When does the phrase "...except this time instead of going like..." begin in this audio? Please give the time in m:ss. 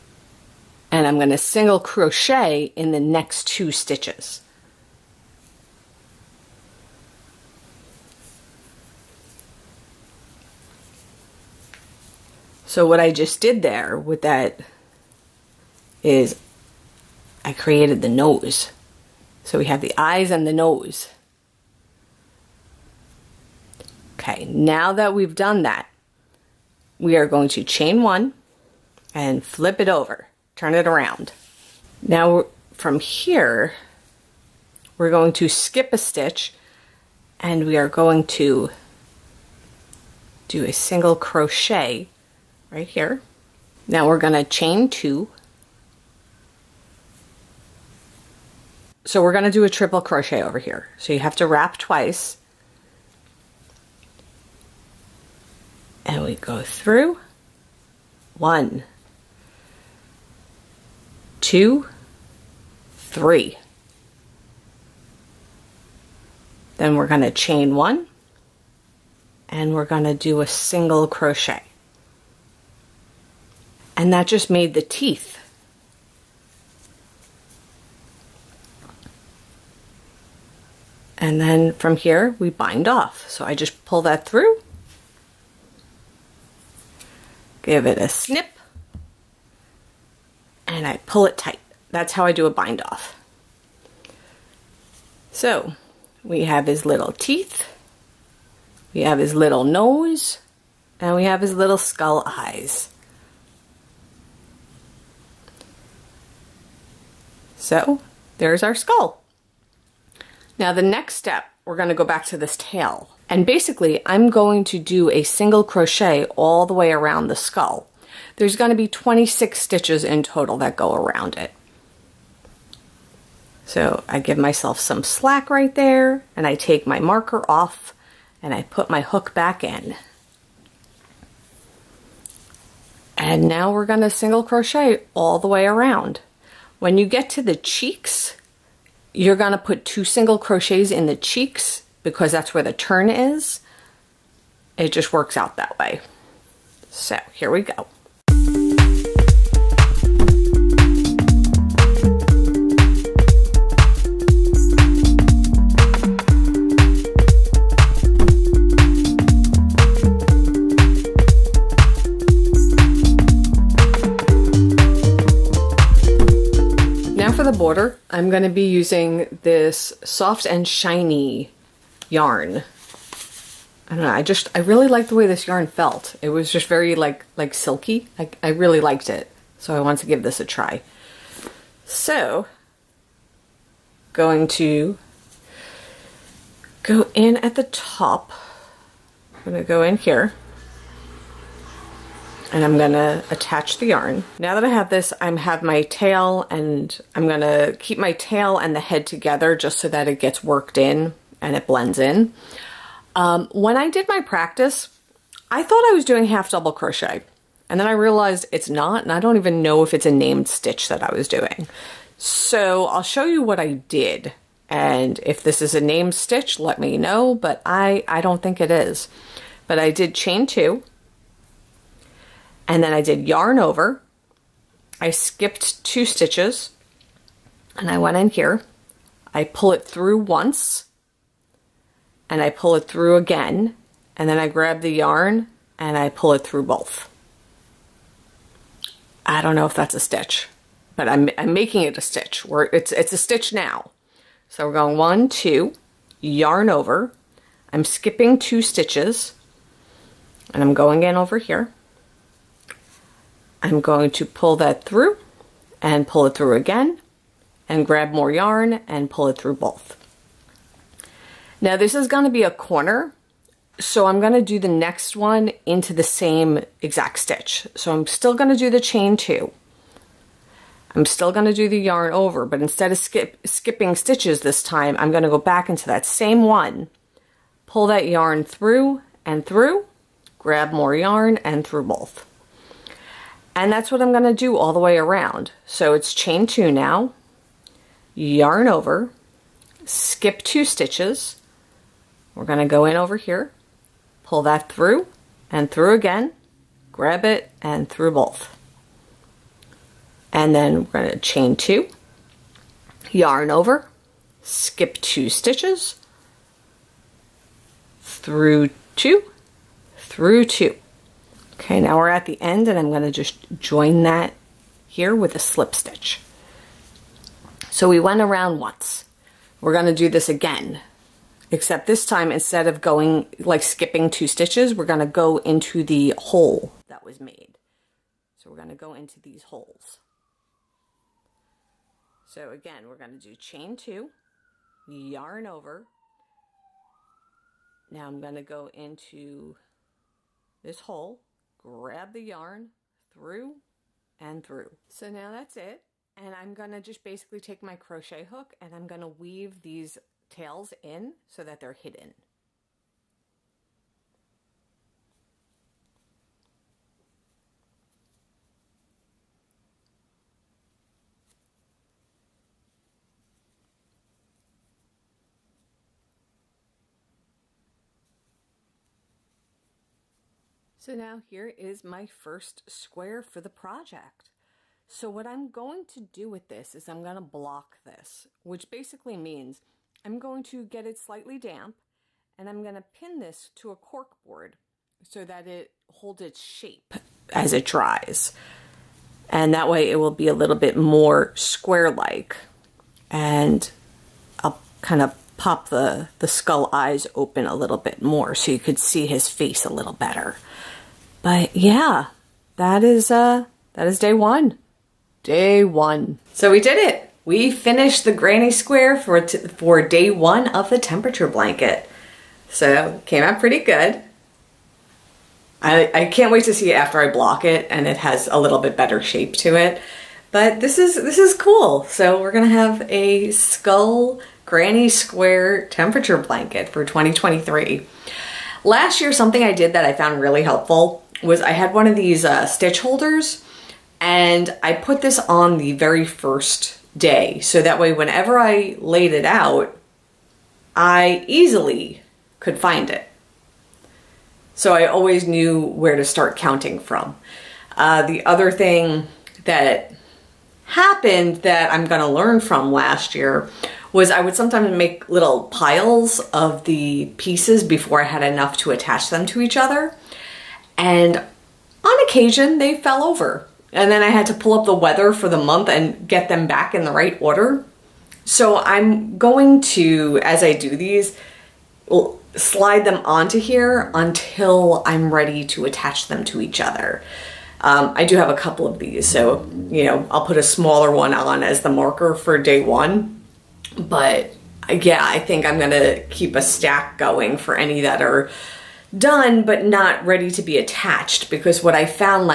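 5:21.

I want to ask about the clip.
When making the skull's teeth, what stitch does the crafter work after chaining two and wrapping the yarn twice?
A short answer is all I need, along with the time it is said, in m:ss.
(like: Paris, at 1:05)
triple crochet, at 0:49.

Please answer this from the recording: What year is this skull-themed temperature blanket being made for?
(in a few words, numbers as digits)
2023.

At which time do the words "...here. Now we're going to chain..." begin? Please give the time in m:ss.
0:42.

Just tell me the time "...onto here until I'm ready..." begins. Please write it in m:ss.
7:53.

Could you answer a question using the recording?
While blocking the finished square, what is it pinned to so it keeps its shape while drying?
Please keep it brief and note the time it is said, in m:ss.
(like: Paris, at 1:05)
cork board, at 6:23.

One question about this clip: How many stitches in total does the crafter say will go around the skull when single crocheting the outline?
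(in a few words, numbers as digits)
26.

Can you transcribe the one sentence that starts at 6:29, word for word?
And that way it will be a little bit more square-like.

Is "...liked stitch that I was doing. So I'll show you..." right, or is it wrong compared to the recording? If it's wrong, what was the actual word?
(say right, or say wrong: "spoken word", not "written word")
wrong: "named", not "liked".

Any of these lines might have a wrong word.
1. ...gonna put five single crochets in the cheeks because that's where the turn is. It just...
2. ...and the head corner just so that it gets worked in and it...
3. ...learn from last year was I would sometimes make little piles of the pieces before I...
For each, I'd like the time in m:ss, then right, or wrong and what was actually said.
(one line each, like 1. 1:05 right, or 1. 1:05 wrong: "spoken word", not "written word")
1. 2:19 wrong: "two", not "five"
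2. 3:18 wrong: "together", not "corner"
3. 7:32 right.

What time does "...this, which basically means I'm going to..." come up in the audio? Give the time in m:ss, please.
6:17.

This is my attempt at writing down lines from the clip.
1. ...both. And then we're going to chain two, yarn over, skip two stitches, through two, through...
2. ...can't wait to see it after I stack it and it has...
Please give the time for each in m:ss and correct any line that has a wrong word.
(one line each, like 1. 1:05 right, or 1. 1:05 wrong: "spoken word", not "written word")
1. 4:58 right
2. 6:56 wrong: "block", not "stack".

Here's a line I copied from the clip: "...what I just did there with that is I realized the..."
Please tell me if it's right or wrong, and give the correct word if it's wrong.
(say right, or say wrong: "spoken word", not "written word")
wrong: "created", not "realized".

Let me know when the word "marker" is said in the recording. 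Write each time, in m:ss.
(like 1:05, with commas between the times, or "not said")
2:06, 8:01.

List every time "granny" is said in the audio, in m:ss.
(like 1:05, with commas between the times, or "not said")
6:48, 7:04.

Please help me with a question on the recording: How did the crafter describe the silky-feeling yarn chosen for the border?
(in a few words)
soft and shiny.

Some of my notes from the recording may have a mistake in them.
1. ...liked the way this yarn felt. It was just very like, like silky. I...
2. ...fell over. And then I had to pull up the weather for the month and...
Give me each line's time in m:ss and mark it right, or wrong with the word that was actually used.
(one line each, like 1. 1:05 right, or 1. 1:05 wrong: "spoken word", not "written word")
1. 2:54 right
2. 7:42 right.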